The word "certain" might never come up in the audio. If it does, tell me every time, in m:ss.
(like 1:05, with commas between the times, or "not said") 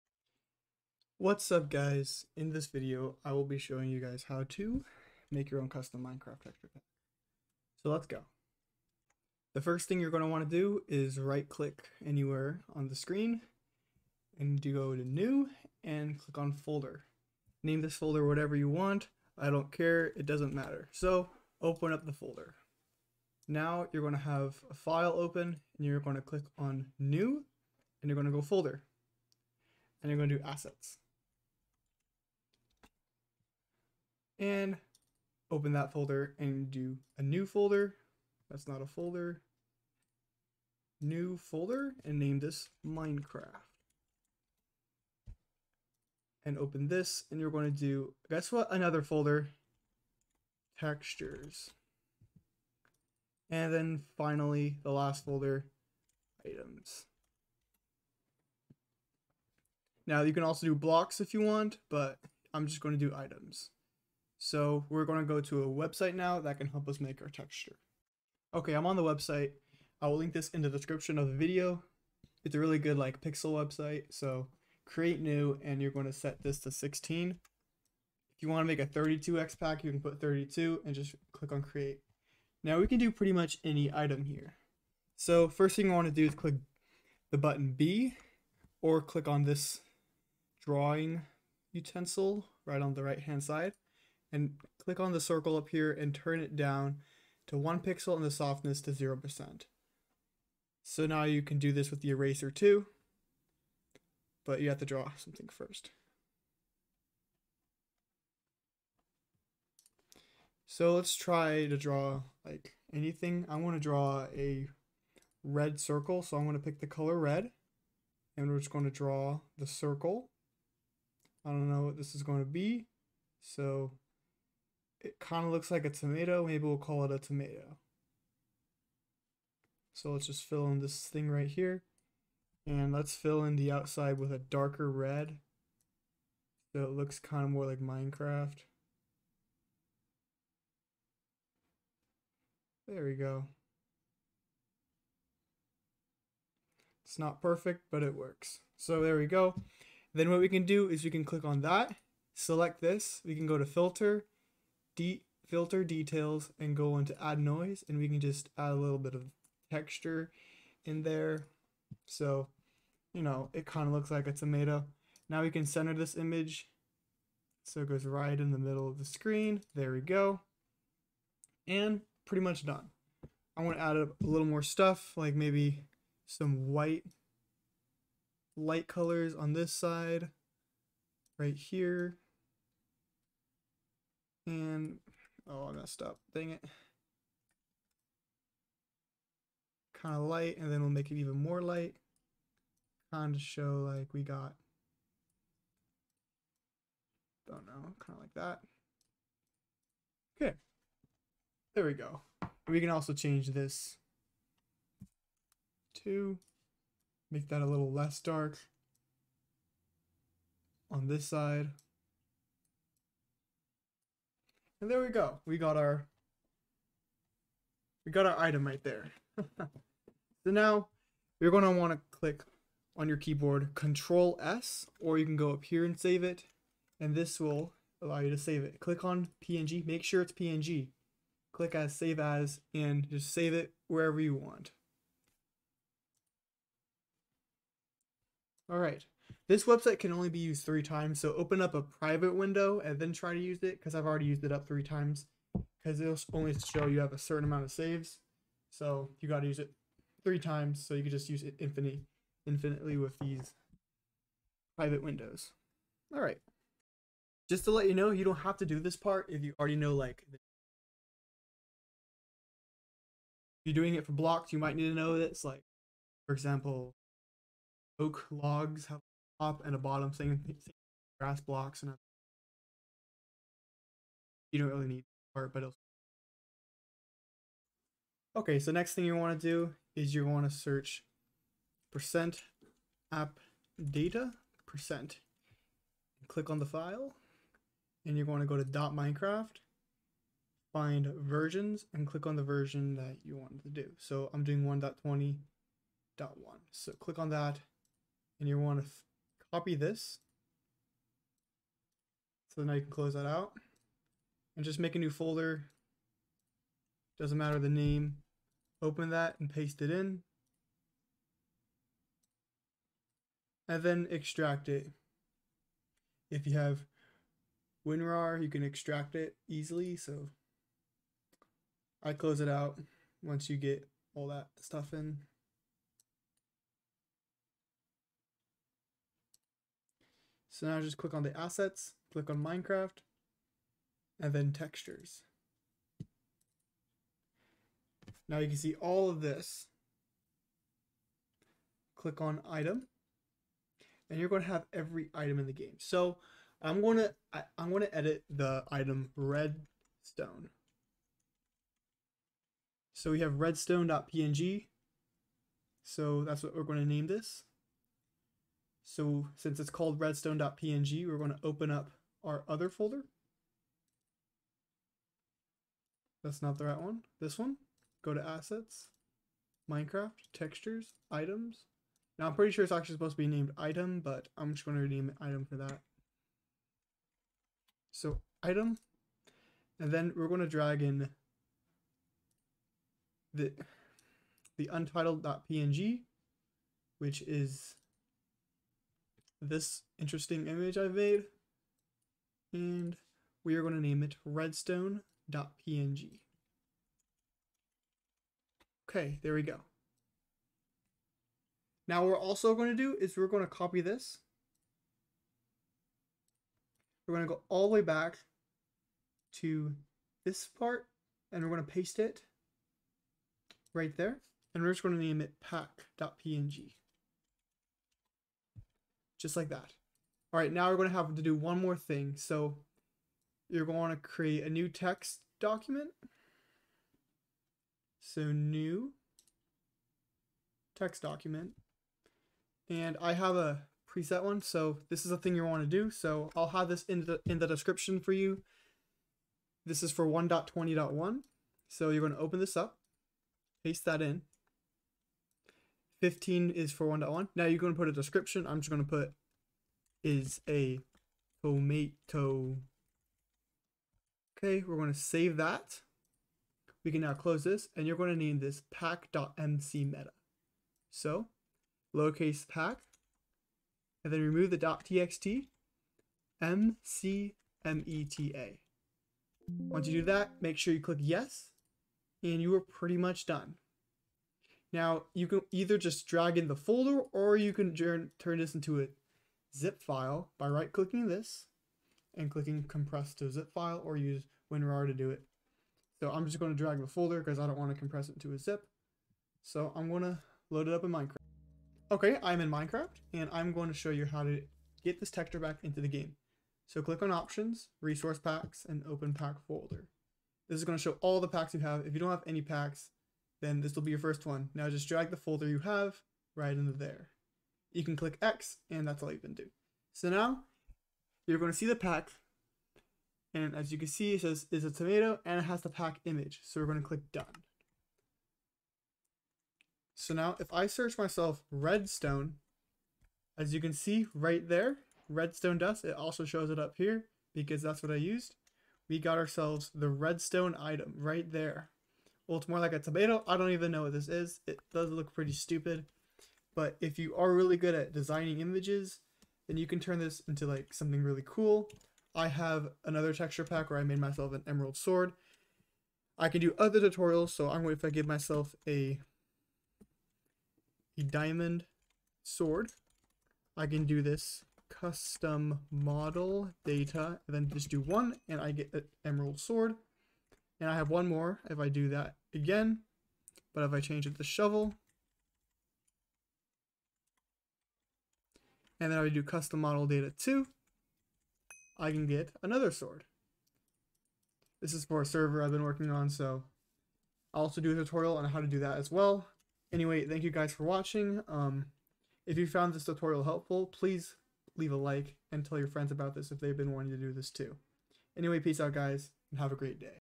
4:07.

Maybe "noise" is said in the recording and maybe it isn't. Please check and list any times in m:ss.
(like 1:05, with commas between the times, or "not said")
2:37.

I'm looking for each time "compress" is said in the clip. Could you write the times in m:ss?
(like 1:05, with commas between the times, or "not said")
8:02, 8:07.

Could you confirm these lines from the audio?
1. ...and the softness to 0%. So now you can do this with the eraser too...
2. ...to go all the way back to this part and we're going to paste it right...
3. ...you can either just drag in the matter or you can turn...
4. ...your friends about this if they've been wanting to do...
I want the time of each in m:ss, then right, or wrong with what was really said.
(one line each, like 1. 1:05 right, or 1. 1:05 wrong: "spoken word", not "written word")
1. 1:38 right
2. 6:47 right
3. 7:55 wrong: "folder", not "matter"
4. 9:45 right.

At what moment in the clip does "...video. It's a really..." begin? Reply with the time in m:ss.
1:11.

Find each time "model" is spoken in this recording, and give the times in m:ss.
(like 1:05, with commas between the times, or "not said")
9:15, 9:29.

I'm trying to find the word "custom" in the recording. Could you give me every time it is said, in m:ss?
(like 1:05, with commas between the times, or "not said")
0:05, 9:14, 9:29.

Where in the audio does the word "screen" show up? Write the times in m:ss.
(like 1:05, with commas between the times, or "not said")
0:12, 2:49.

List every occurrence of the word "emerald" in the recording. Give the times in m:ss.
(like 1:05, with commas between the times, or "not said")
9:04, 9:19.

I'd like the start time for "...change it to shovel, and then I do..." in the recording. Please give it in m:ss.
9:23.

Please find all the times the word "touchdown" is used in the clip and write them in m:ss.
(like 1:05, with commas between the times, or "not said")
not said.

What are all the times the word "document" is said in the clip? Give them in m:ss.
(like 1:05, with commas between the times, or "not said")
7:05, 7:11.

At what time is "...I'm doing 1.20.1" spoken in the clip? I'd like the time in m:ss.
4:54.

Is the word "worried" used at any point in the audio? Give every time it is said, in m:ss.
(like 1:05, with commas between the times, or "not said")
not said.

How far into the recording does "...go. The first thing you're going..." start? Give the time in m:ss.
0:08.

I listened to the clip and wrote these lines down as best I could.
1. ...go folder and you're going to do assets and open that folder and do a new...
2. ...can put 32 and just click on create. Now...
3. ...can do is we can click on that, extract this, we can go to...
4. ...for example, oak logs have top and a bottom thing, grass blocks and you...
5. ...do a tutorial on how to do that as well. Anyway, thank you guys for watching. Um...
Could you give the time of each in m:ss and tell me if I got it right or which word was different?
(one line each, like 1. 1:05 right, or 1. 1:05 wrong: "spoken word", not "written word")
1. 0:28 right
2. 1:19 right
3. 2:30 wrong: "select", not "extract"
4. 4:26 right
5. 9:37 right.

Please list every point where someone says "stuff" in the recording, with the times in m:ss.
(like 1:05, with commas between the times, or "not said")
2:54, 5:24.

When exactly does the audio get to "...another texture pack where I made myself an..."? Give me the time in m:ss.
9:02.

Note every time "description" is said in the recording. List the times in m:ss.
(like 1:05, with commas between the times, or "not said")
1:10, 7:17, 7:27.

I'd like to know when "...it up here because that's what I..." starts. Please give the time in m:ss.
8:46.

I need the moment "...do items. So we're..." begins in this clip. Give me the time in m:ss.
1:03.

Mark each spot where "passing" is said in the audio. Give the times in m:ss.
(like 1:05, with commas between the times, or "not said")
not said.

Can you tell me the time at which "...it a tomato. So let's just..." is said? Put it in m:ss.
2:07.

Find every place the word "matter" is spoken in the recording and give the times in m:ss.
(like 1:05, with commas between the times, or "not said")
0:20, 5:07.